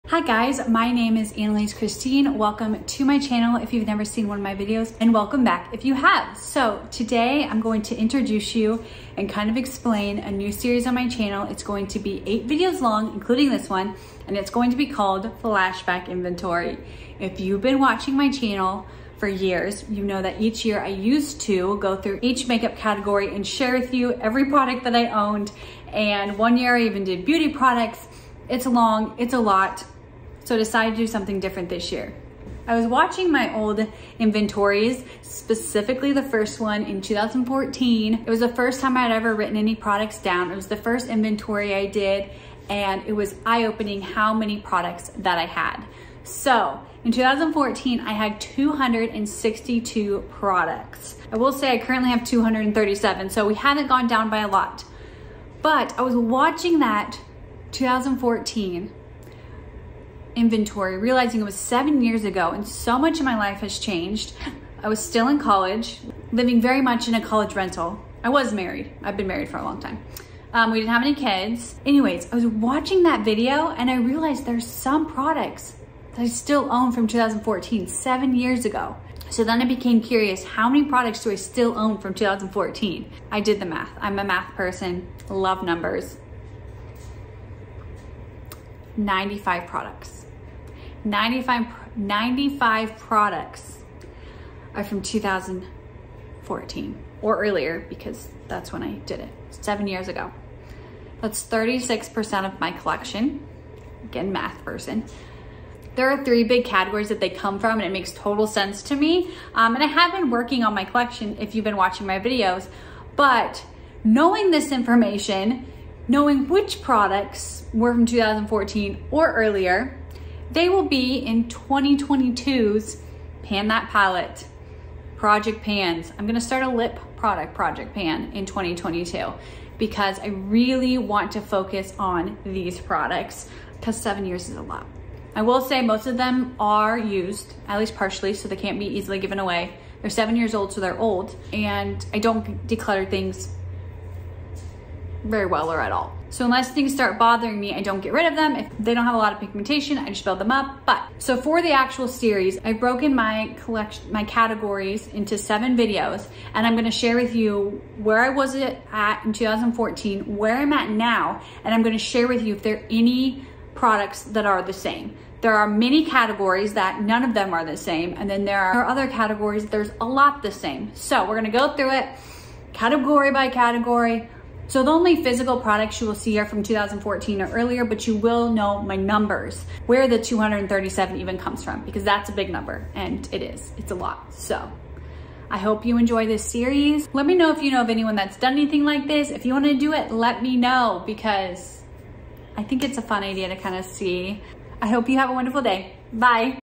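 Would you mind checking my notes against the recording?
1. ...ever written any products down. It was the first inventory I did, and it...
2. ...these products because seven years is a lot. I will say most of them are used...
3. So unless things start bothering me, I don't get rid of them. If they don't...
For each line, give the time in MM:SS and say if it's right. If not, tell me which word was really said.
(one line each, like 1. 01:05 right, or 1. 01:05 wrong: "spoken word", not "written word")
1. 00:39 right
2. 02:12 right
3. 02:26 right.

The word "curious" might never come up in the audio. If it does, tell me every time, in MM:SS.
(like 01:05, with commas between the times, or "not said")
01:20.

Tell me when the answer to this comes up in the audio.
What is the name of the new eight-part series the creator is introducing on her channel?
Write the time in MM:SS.
00:15.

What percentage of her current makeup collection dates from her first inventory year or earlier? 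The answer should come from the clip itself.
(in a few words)
36%.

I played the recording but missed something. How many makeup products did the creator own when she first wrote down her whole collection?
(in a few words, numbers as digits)
262.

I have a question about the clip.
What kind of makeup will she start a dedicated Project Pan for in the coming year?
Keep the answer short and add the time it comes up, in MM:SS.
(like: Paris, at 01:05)
lip product, at 02:06.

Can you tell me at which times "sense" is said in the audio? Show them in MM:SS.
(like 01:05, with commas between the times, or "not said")
01:48.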